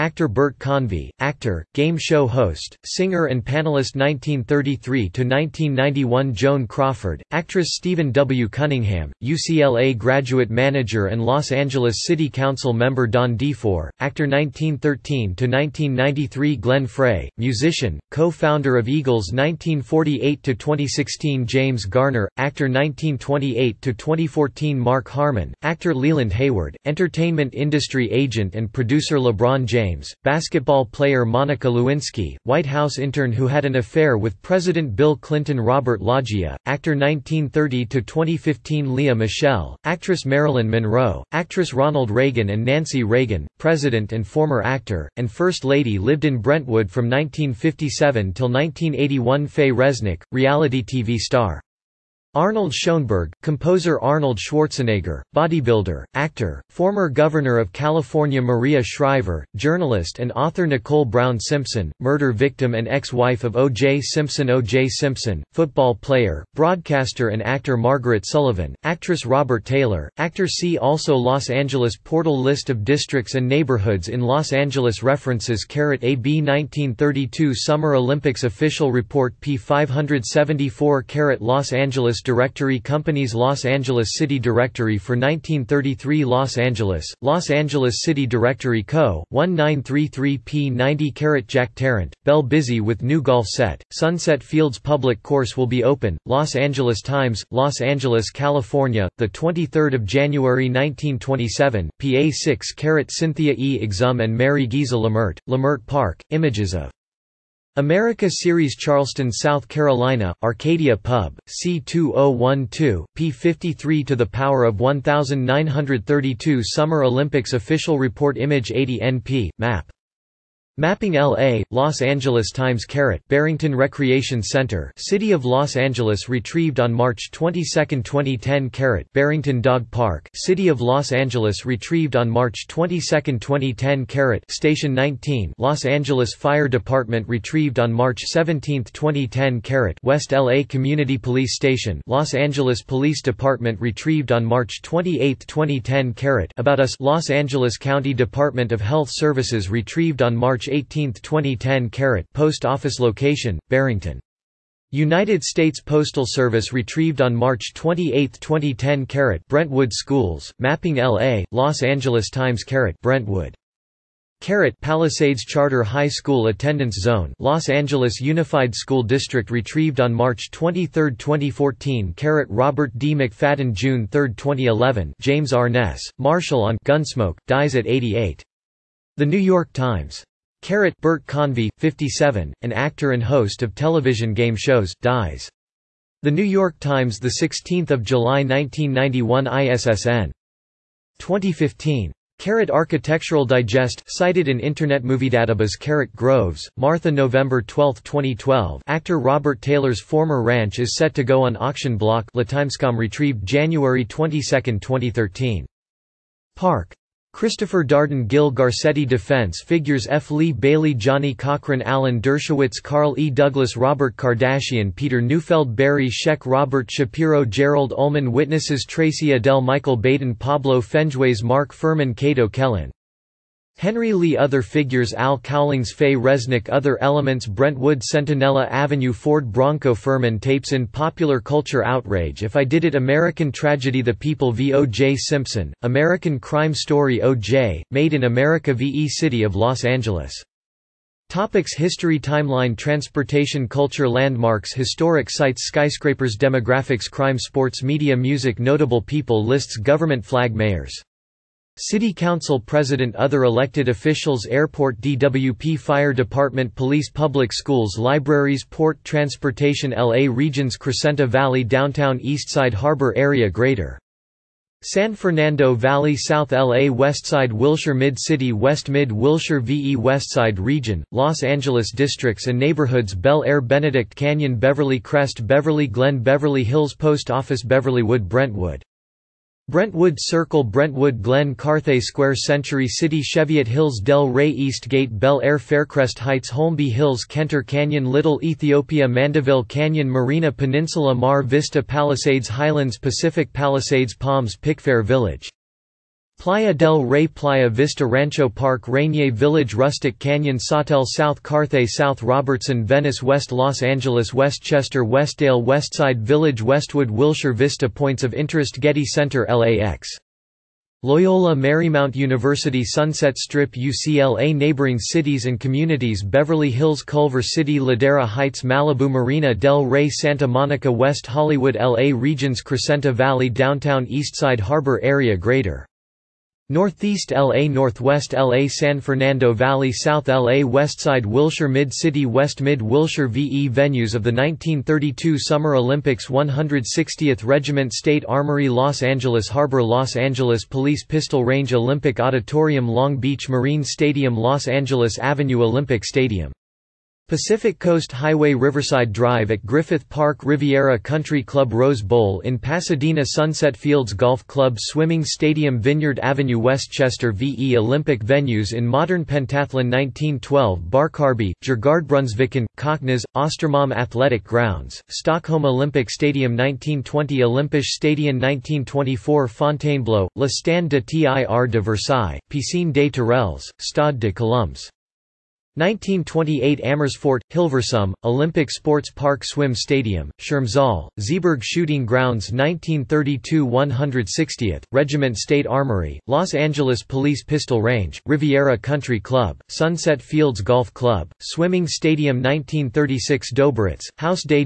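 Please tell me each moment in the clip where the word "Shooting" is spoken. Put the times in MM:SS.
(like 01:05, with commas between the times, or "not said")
06:21.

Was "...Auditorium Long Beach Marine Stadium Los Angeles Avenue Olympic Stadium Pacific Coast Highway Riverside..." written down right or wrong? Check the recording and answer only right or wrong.
right.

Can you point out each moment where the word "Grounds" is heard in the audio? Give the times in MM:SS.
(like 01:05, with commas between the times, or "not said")
06:04, 06:22.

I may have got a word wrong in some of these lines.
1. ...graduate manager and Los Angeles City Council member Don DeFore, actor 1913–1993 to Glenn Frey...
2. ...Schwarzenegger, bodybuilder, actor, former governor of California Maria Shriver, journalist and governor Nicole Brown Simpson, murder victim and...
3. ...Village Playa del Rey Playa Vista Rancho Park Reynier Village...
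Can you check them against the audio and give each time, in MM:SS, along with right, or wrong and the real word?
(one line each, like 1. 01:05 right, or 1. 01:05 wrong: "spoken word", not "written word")
1. 00:09 right
2. 00:54 wrong: "author", not "governor"
3. 04:55 right.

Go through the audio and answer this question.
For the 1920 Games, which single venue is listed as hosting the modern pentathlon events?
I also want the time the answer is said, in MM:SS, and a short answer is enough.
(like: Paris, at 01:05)
Olympisch Stadion, at 06:07.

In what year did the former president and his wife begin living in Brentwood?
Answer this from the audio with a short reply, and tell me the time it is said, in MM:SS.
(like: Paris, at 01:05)
1957, at 00:47.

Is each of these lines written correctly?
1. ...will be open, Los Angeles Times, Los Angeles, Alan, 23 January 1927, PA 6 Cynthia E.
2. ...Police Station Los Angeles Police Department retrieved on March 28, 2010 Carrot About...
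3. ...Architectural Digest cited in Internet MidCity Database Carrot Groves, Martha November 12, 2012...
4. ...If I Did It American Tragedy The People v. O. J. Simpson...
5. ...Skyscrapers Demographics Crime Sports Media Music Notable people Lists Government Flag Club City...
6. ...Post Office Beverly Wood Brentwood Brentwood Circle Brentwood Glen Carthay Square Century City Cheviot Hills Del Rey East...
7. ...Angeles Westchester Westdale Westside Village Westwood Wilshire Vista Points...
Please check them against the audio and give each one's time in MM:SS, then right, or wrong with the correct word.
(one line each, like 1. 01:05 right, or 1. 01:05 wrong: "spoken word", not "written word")
1. 01:35 wrong: "California", not "Alan"
2. 02:21 right
3. 03:12 wrong: "Movie", not "MidCity"
4. 03:52 right
5. 04:05 wrong: "Mayors", not "Club"
6. 04:36 right
7. 05:03 right.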